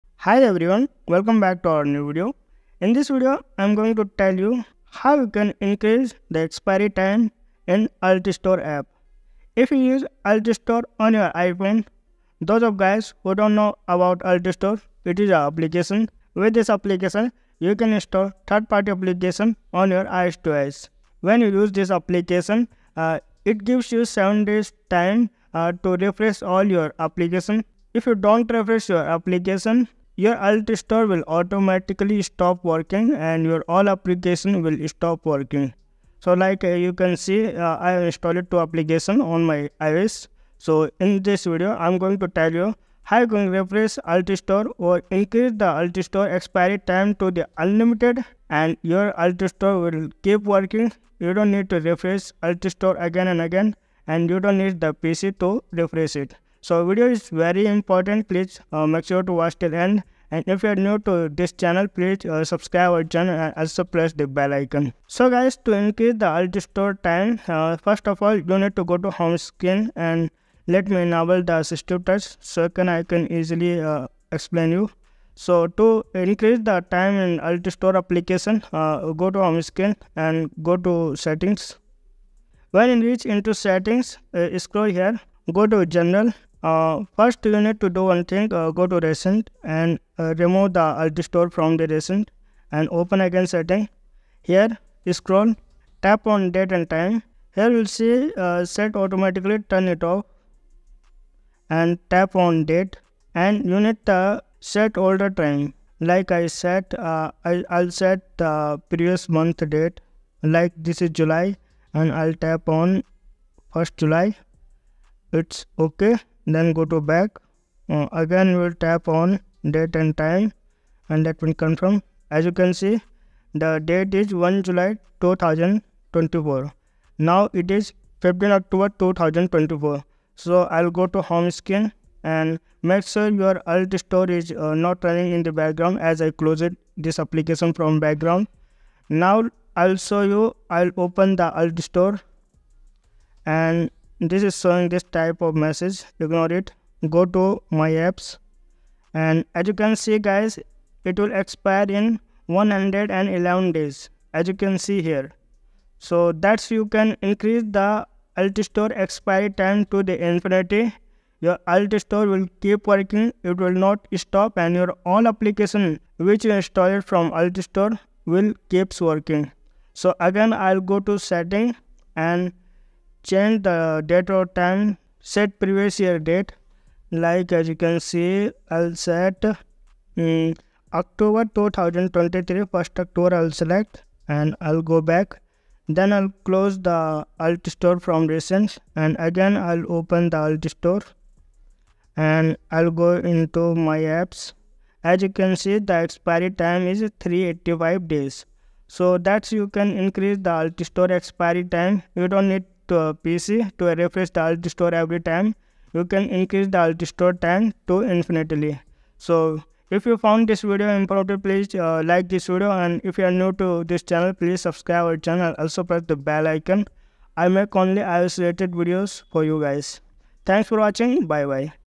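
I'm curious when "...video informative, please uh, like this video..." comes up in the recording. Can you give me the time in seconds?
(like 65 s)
210 s.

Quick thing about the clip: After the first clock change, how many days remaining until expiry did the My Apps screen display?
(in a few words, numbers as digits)
111 days.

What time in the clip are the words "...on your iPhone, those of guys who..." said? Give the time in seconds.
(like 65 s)
10 s.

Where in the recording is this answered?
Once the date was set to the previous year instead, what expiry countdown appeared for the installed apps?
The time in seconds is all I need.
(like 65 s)
197 s.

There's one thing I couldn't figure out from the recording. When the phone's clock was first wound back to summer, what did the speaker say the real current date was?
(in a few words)
15 October 2024.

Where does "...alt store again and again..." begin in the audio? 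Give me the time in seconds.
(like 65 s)
52 s.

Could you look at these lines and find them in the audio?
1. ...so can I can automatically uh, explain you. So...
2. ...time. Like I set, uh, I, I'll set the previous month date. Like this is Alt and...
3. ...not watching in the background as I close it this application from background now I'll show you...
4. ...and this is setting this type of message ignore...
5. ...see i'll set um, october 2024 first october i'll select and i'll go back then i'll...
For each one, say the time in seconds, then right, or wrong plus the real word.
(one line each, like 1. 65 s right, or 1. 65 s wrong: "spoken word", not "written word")
1. 72 s wrong: "easily", not "automatically"
2. 105 s wrong: "July", not "Alt"
3. 134 s wrong: "running", not "watching"
4. 143 s wrong: "showing", not "setting"
5. 177 s wrong: "2023", not "2024".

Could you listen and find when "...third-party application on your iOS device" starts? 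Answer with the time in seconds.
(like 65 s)
18 s.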